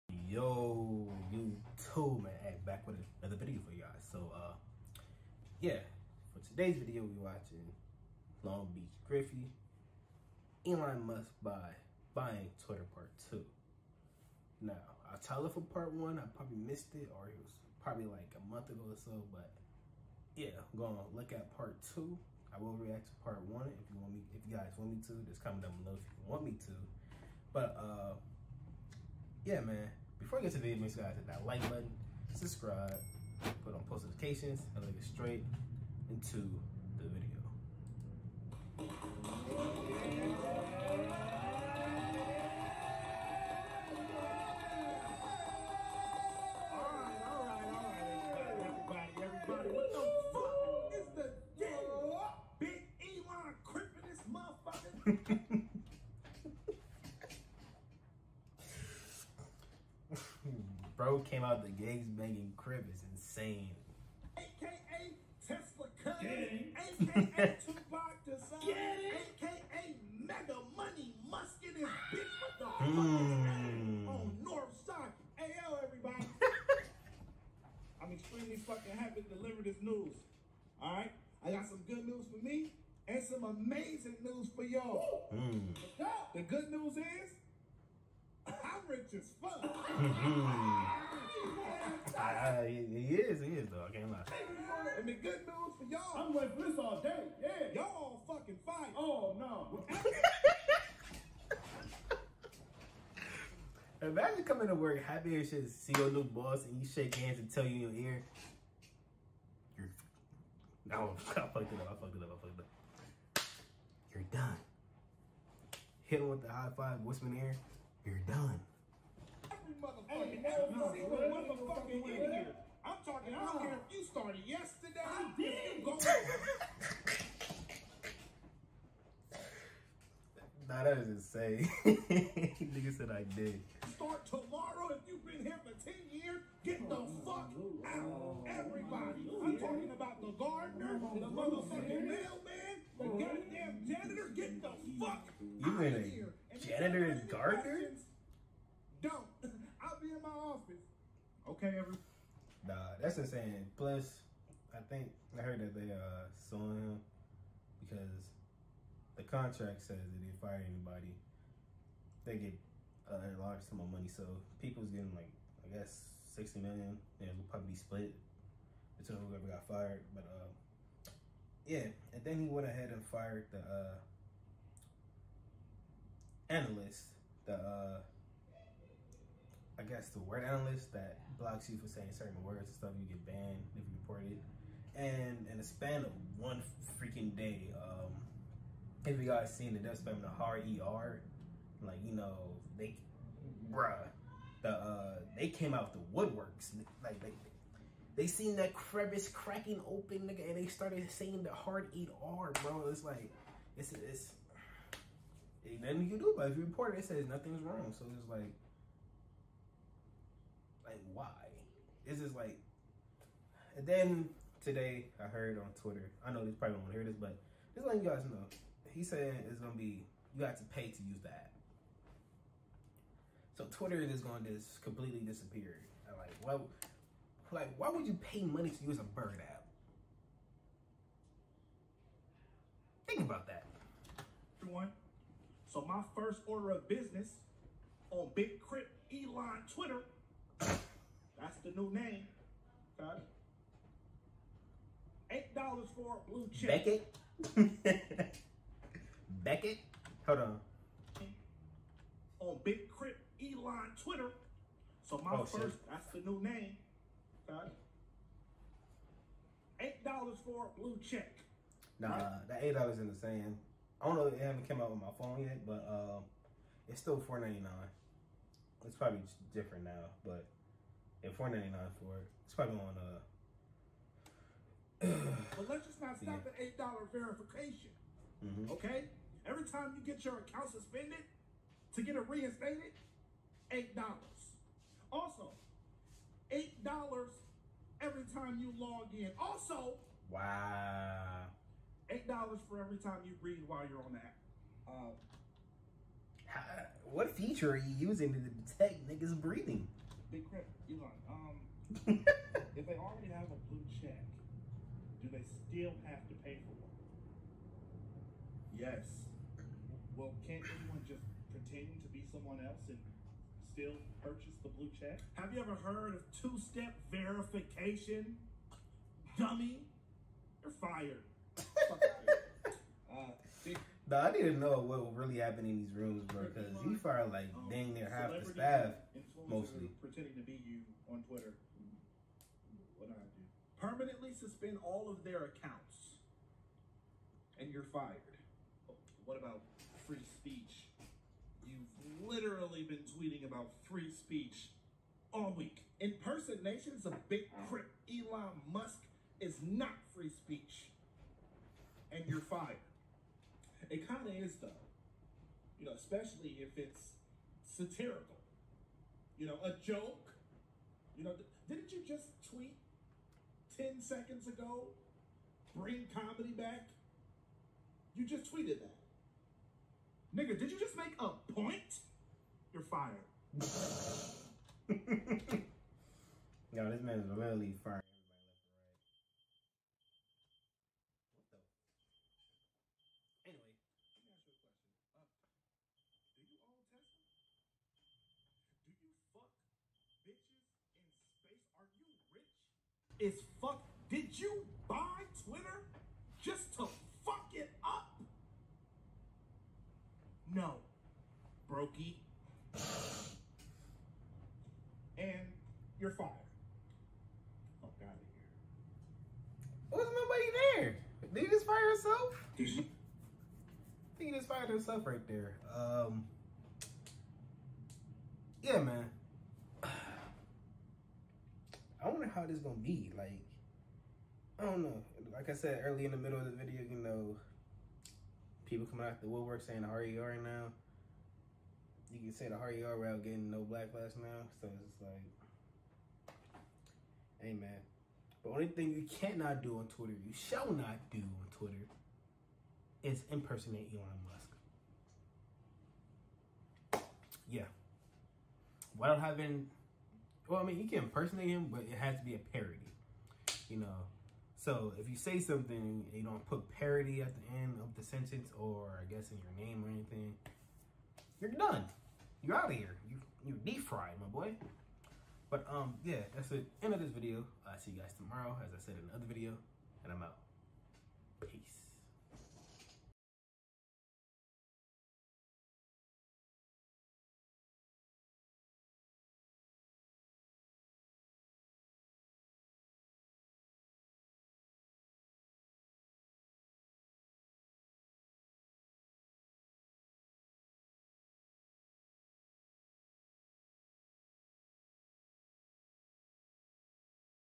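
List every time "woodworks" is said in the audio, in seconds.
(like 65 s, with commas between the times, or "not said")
196 s, 429 s.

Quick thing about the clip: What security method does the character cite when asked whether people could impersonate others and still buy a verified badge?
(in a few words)
Two-step verification.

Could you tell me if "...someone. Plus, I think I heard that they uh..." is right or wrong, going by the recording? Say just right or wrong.
wrong.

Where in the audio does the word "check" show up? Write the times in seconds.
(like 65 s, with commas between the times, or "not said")
246 s, 261 s, 304 s, 314 s.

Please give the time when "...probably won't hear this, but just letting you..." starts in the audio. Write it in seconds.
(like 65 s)
216 s.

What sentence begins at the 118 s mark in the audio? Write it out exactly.
You're done motherfucking, every single motherfucking I'm talking, I don't care if you started yesterday.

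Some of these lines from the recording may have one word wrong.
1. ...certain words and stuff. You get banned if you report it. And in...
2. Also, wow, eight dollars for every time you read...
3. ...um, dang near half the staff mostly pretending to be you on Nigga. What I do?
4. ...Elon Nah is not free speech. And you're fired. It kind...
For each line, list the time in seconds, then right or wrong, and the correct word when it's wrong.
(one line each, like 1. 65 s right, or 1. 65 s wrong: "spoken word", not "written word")
1. 182 s right
2. 289 s right
3. 327 s wrong: "Twitter", not "Nigga"
4. 348 s wrong: "Musk", not "Nah".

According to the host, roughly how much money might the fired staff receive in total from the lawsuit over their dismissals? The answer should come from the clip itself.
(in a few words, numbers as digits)
60 million.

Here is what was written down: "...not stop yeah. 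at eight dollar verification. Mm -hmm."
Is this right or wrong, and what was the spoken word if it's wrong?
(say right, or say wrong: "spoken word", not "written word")
right.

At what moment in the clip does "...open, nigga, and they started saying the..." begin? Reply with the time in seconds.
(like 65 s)
199 s.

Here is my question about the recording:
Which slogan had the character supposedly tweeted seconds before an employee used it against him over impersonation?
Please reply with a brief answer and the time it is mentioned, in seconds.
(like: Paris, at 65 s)
Bring comedy back, at 365 s.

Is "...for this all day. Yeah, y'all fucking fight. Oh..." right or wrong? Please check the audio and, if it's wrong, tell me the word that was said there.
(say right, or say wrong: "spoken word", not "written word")
right.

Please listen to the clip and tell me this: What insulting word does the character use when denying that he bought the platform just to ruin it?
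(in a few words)
Brokey.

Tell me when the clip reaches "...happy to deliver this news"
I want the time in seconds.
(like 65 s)
78 s.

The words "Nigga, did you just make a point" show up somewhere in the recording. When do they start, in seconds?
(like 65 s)
370 s.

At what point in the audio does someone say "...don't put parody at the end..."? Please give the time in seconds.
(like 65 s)
456 s.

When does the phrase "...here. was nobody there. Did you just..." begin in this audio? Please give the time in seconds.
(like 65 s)
408 s.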